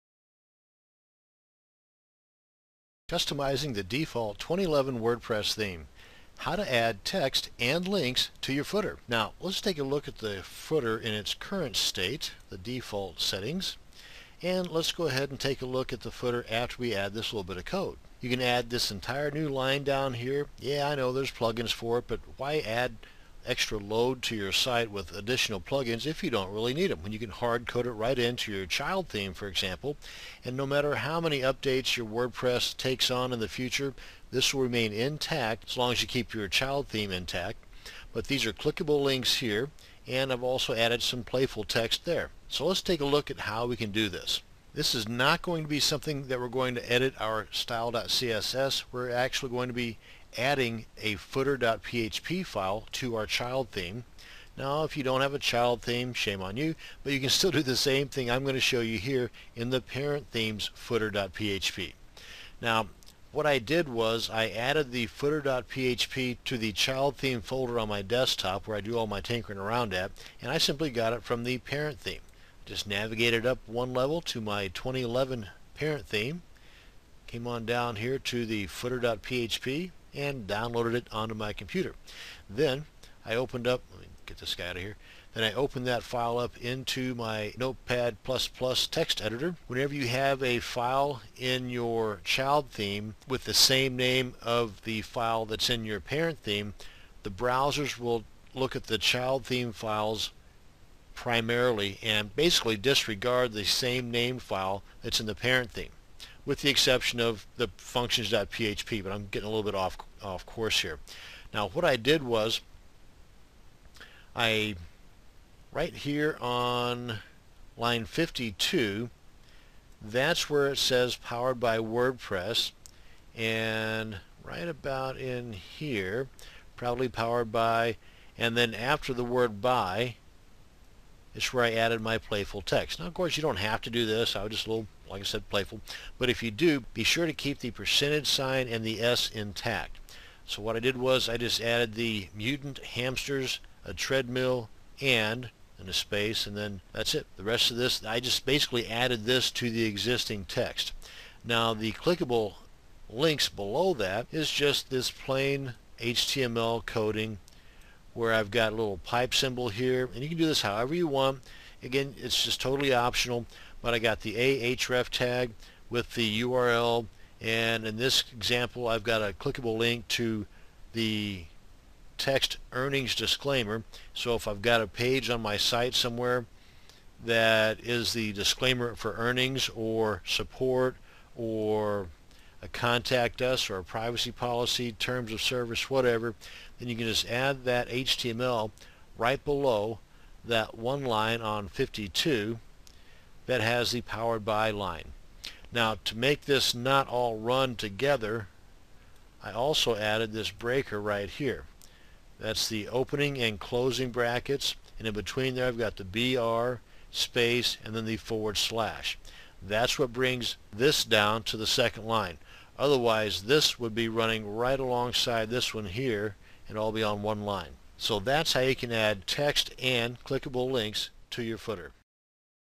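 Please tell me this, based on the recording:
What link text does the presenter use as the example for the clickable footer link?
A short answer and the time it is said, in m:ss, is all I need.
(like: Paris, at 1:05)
earnings disclaimer, at 2:52.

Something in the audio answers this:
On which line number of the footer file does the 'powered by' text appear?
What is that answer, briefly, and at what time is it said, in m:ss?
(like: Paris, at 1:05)
52, at 1:57.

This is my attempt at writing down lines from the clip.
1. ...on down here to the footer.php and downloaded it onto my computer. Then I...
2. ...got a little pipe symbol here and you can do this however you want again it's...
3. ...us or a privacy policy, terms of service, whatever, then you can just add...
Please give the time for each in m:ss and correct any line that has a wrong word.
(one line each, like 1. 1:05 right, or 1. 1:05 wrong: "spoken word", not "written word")
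1. 1:17 right
2. 2:38 right
3. 3:03 right.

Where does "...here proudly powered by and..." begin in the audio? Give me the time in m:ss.
2:05.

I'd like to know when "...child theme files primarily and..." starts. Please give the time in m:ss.
1:38.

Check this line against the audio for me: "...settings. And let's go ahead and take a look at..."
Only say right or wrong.
right.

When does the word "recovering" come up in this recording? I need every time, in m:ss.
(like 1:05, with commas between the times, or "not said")
not said.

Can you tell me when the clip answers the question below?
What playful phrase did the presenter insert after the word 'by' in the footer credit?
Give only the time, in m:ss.
2:22.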